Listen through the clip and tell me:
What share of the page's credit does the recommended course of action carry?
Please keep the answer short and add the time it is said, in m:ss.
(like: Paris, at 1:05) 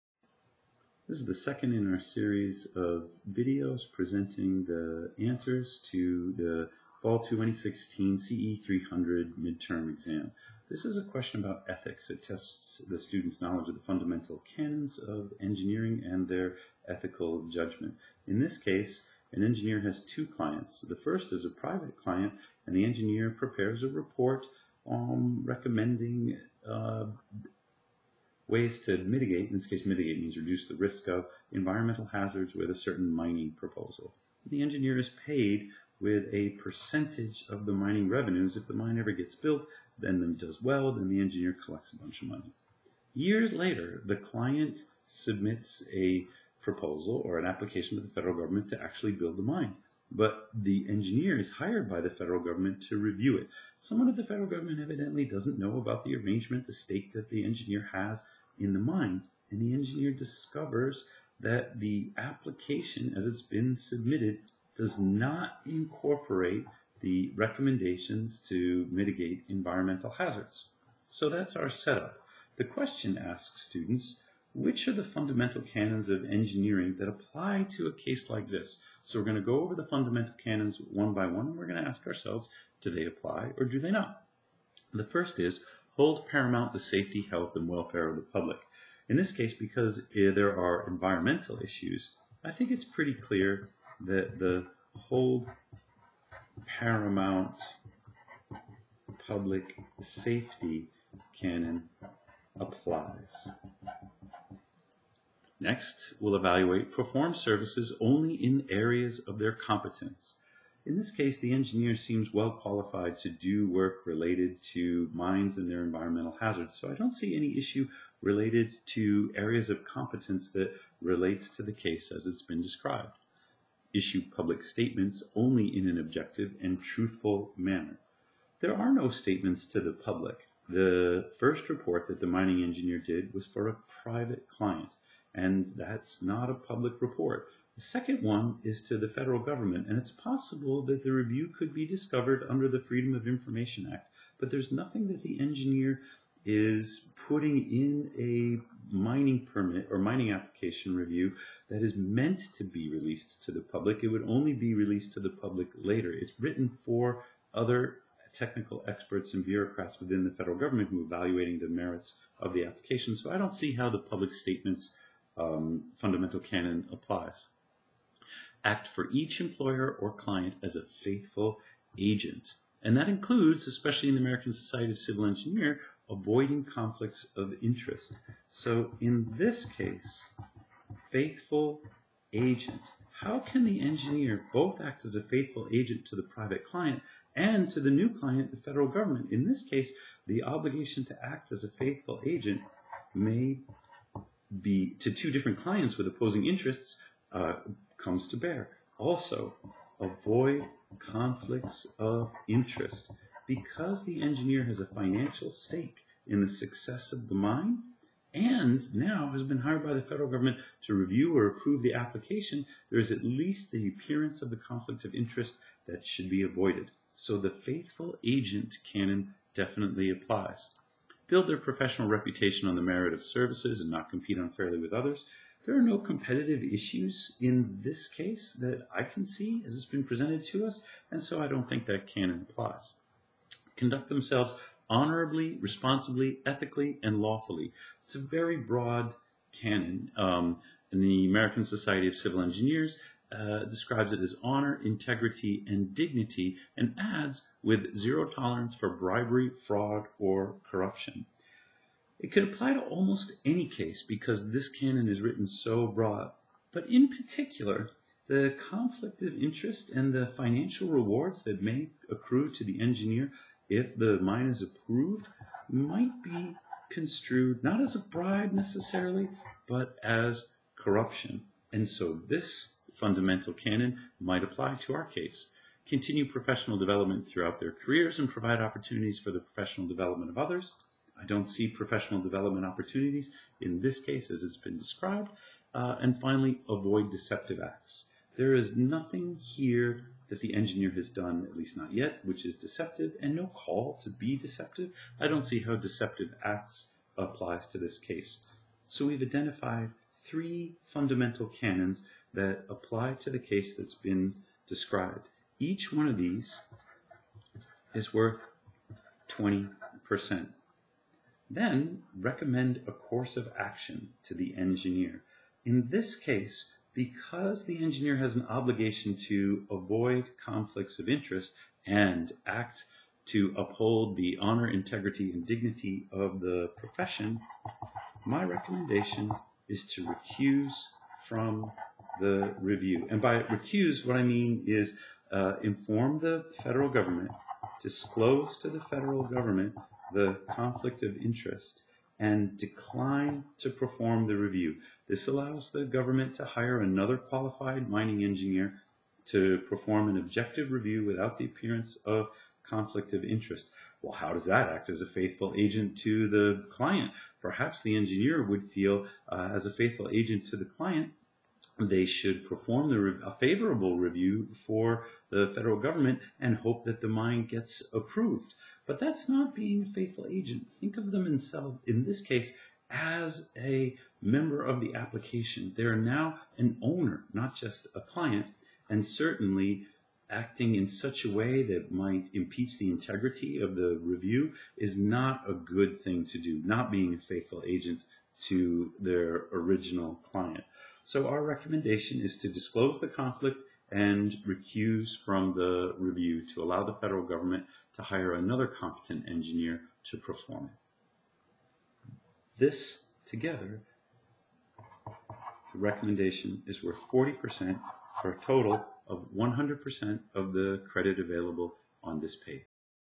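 40%, at 6:47.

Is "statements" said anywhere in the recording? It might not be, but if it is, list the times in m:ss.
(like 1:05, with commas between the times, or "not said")
2:04, 2:09, 2:44.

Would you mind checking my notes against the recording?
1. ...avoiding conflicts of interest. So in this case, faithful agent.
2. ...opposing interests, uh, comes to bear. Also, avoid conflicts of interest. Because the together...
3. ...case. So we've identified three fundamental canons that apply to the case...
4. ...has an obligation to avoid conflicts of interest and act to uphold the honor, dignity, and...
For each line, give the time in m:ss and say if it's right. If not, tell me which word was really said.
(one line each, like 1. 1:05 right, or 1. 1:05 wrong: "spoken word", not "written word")
1. 2:56 right
2. 3:16 wrong: "engineer", not "together"
3. 4:57 right
4. 5:18 wrong: "integrity", not "dignity".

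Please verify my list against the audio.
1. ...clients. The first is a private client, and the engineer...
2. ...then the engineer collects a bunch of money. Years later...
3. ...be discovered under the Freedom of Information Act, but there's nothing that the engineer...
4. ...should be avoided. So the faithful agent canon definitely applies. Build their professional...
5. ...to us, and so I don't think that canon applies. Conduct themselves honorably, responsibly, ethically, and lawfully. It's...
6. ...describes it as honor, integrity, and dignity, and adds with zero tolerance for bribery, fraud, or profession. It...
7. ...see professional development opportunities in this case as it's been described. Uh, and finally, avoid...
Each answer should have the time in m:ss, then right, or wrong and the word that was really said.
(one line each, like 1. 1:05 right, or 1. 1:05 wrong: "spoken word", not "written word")
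1. 0:20 right
2. 0:40 right
3. 2:21 right
4. 3:36 right
5. 3:50 right
6. 4:03 wrong: "corruption", not "profession"
7. 4:41 right.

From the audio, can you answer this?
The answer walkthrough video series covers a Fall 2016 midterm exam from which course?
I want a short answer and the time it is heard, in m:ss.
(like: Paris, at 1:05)
CEE 300, at 0:08.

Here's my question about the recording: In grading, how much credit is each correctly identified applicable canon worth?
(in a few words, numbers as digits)
20%.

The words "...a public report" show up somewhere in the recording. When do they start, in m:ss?
2:16.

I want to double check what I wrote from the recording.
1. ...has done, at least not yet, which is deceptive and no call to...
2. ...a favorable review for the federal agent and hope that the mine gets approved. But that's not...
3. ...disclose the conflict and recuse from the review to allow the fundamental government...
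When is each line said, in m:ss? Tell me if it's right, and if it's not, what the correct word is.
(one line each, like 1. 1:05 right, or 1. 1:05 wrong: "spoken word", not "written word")
1. 4:50 right
2. 6:03 wrong: "government", not "agent"
3. 6:32 wrong: "federal", not "fundamental".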